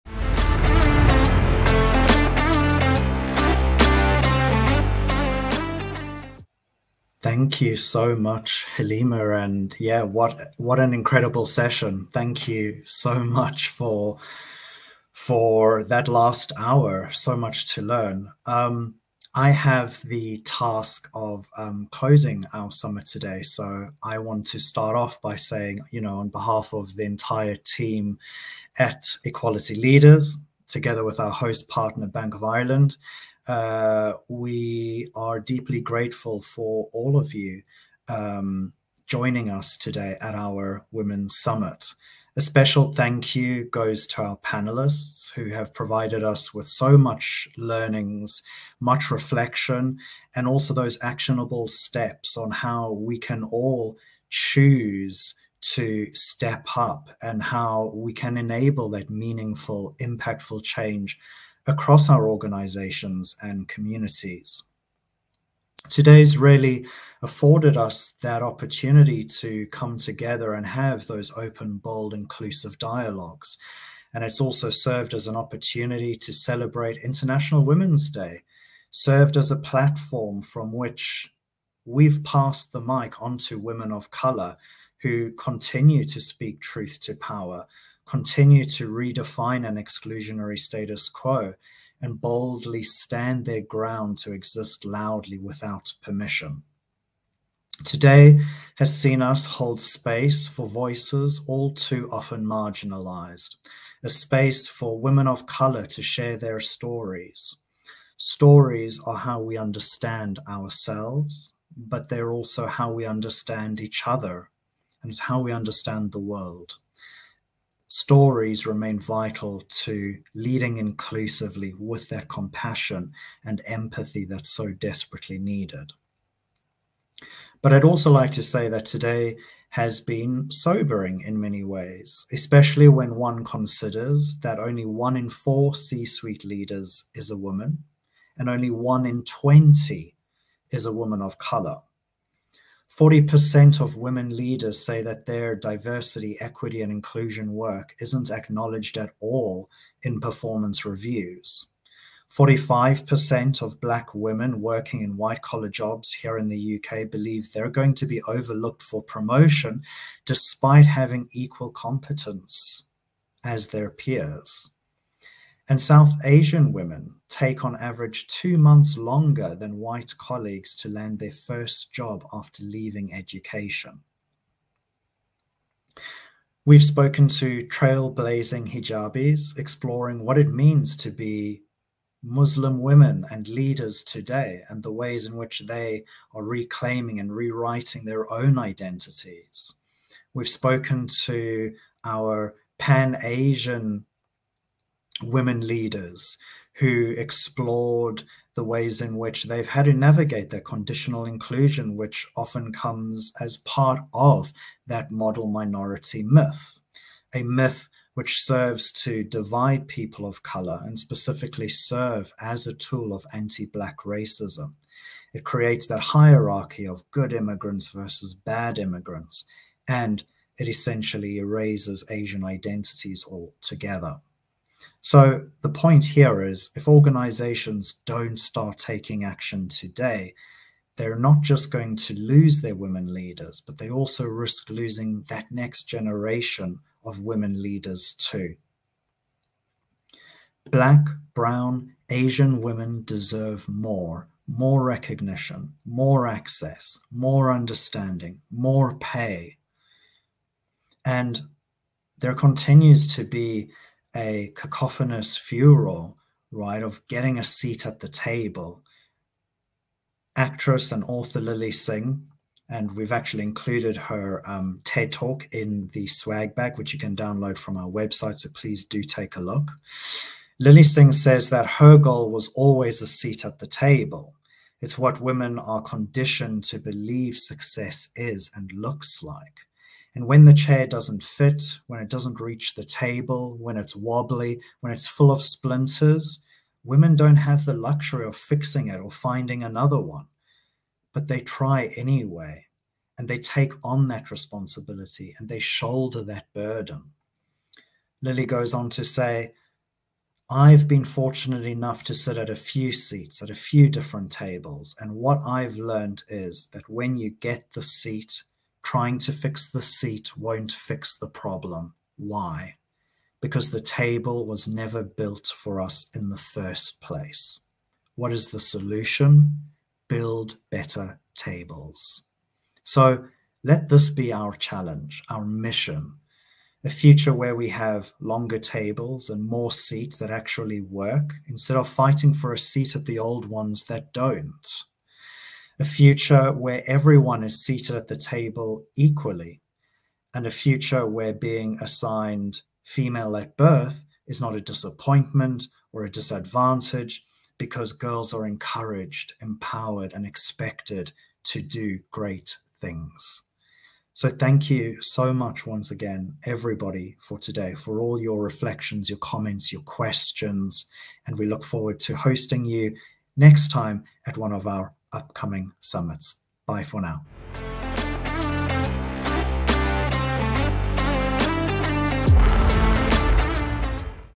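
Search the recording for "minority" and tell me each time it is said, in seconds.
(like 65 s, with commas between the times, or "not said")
205 s.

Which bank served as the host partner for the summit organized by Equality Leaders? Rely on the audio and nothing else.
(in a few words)
Bank of Ireland.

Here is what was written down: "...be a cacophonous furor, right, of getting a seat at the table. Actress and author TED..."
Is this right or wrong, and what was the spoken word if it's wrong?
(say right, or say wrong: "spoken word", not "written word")
wrong: "Lilly", not "TED".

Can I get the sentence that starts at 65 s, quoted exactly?
Today's really afforded us that opportunity to come together and have those open, bold, inclusive dialogues.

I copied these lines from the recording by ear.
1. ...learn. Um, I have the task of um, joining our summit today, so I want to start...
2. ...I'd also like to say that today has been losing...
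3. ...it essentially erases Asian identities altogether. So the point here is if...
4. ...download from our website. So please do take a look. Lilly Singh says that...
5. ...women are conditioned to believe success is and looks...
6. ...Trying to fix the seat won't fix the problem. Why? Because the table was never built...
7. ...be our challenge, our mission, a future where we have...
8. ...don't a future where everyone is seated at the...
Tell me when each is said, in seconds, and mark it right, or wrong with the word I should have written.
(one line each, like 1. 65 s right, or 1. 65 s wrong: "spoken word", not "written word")
1. 17 s wrong: "closing", not "joining"
2. 127 s wrong: "sobering", not "losing"
3. 220 s right
4. 267 s right
5. 275 s right
6. 308 s right
7. 324 s right
8. 334 s right.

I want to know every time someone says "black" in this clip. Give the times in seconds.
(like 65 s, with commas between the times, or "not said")
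153 s, 213 s, 240 s.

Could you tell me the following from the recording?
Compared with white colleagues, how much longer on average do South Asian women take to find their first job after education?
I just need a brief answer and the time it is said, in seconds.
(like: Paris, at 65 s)
2 months, at 168 s.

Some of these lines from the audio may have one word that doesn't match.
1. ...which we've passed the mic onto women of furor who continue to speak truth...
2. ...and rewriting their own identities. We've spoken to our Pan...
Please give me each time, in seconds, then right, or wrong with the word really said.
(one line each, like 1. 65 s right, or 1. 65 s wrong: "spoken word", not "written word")
1. 80 s wrong: "color", not "furor"
2. 187 s right.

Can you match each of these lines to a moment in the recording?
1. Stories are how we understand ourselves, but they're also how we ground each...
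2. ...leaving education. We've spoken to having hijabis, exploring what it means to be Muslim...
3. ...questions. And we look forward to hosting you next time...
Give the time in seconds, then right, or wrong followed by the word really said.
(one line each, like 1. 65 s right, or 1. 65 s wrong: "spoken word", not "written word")
1. 108 s wrong: "understand", not "ground"
2. 172 s wrong: "trailblazing", not "having"
3. 359 s right.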